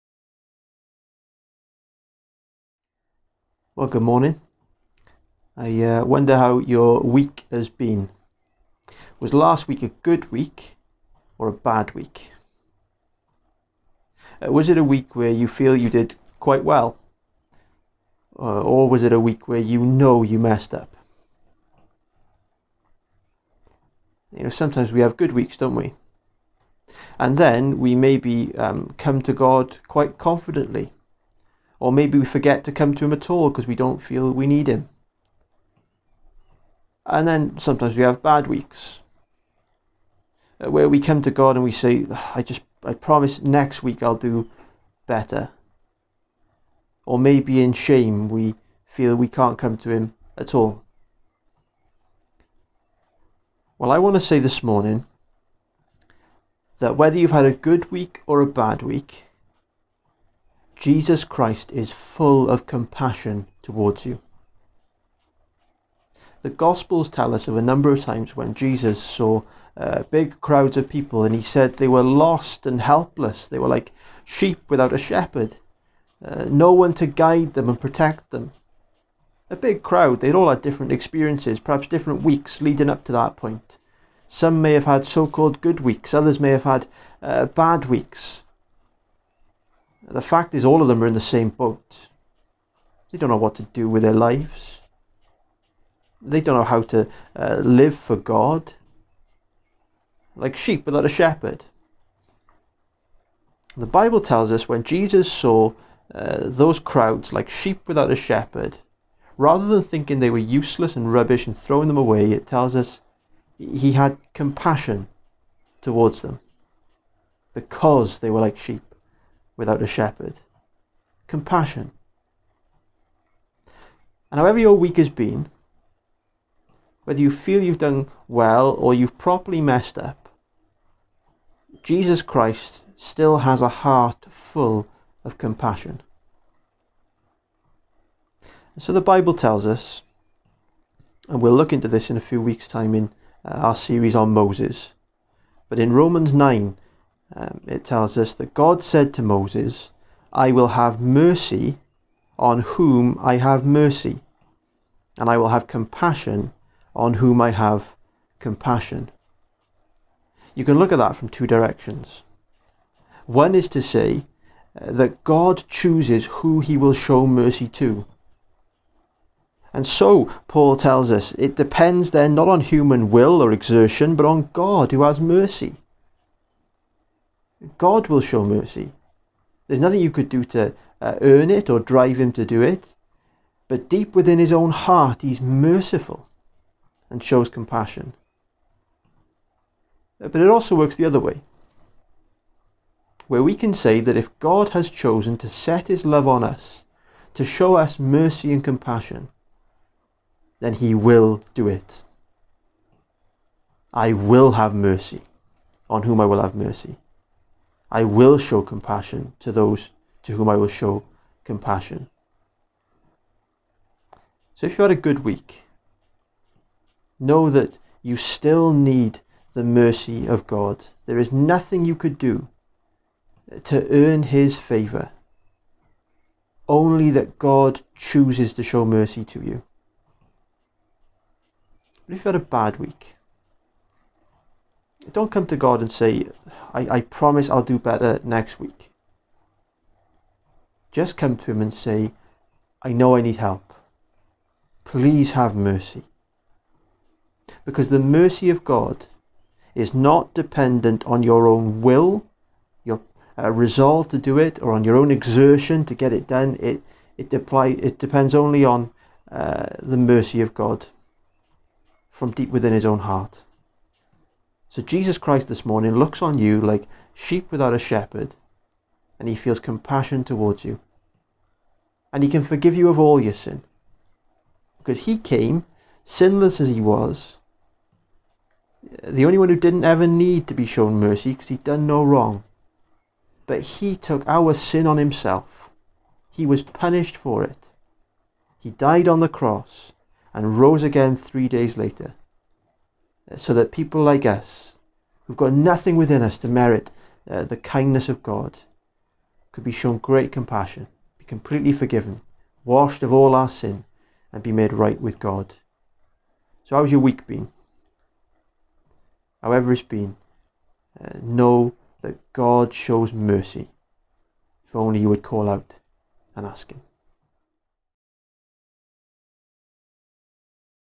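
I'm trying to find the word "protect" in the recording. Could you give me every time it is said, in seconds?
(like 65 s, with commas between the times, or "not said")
77 s.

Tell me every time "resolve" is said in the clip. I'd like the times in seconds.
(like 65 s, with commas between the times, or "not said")
253 s.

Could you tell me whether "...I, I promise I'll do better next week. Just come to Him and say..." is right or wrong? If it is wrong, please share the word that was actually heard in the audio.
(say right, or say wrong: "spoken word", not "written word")
right.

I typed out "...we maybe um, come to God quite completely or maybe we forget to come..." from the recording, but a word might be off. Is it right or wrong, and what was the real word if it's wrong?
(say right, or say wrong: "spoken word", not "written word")
wrong: "confidently", not "completely".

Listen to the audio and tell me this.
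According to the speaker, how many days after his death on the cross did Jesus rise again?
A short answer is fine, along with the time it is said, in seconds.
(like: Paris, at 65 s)
3, at 291 s.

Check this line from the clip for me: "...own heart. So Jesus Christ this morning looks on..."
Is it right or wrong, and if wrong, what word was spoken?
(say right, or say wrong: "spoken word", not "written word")
right.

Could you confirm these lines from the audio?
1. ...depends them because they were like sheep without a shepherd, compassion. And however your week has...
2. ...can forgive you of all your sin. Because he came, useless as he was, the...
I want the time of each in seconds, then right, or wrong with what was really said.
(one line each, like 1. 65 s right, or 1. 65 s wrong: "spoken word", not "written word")
1. 115 s wrong: "towards", not "depends"
2. 272 s wrong: "sinless", not "useless".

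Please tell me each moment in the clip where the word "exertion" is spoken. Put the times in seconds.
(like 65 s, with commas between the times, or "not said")
173 s, 255 s.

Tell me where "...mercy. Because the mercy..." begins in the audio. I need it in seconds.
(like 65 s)
245 s.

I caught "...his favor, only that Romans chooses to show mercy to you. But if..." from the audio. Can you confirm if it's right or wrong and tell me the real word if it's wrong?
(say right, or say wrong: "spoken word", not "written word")
wrong: "God", not "Romans".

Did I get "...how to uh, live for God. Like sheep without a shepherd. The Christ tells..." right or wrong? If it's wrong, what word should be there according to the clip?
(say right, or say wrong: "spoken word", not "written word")
wrong: "Bible", not "Christ".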